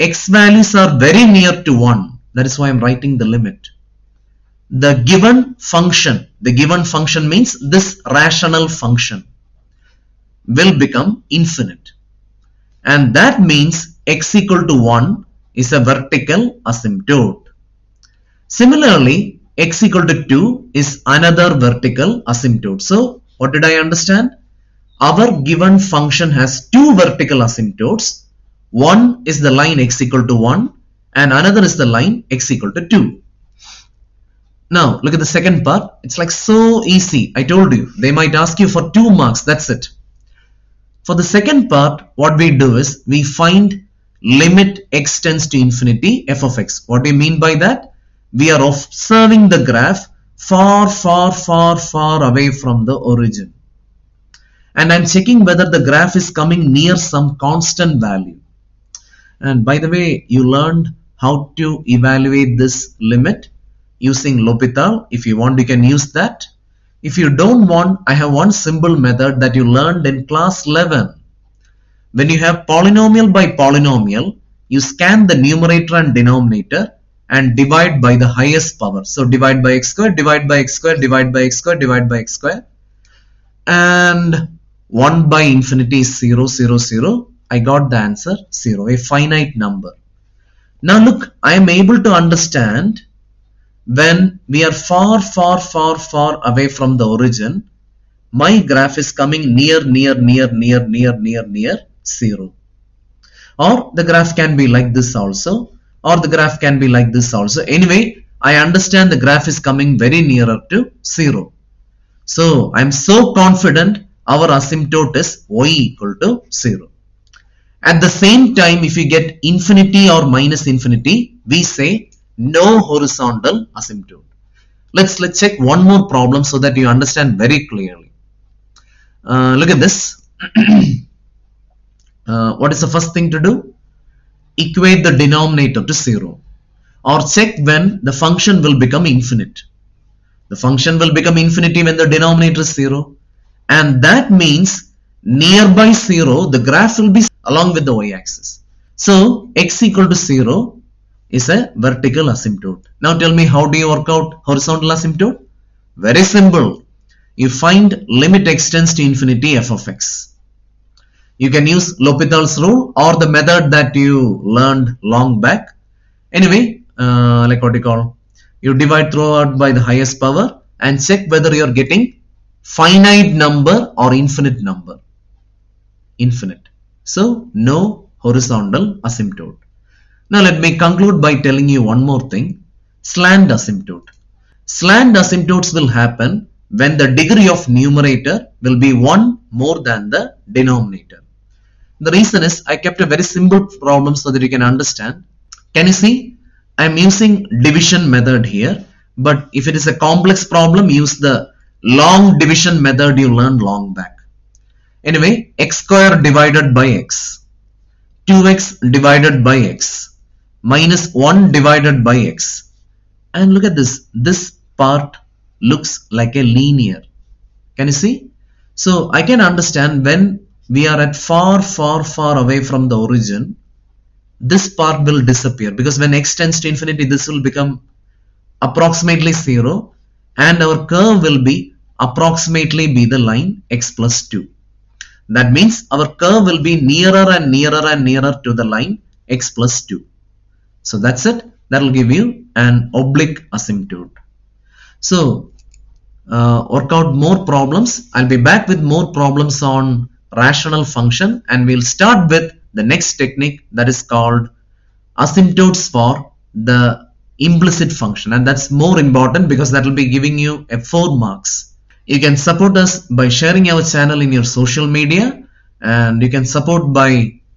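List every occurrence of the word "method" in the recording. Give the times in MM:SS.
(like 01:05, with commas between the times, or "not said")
01:08, 02:43, 03:18, 03:22.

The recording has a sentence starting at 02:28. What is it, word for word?
So x equal to 0 is a vertical asymptote.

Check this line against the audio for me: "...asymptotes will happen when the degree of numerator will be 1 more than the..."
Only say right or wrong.
right.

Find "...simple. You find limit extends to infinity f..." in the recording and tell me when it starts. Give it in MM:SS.
02:36.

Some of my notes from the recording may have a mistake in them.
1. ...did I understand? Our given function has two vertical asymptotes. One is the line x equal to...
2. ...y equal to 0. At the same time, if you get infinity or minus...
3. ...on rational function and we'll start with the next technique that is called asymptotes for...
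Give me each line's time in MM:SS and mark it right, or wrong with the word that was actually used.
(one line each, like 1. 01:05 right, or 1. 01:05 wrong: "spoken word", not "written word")
1. 00:23 right
2. 01:55 right
3. 04:09 right.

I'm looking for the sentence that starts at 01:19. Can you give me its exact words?
So divide by x square, divide by x square, divide by x square, divide by x square.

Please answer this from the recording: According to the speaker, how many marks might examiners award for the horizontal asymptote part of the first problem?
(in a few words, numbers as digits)
2.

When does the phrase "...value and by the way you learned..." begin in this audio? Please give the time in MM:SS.
00:57.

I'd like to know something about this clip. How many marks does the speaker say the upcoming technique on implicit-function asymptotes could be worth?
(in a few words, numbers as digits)
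4.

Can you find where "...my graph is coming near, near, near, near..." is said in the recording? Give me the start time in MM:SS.
01:38.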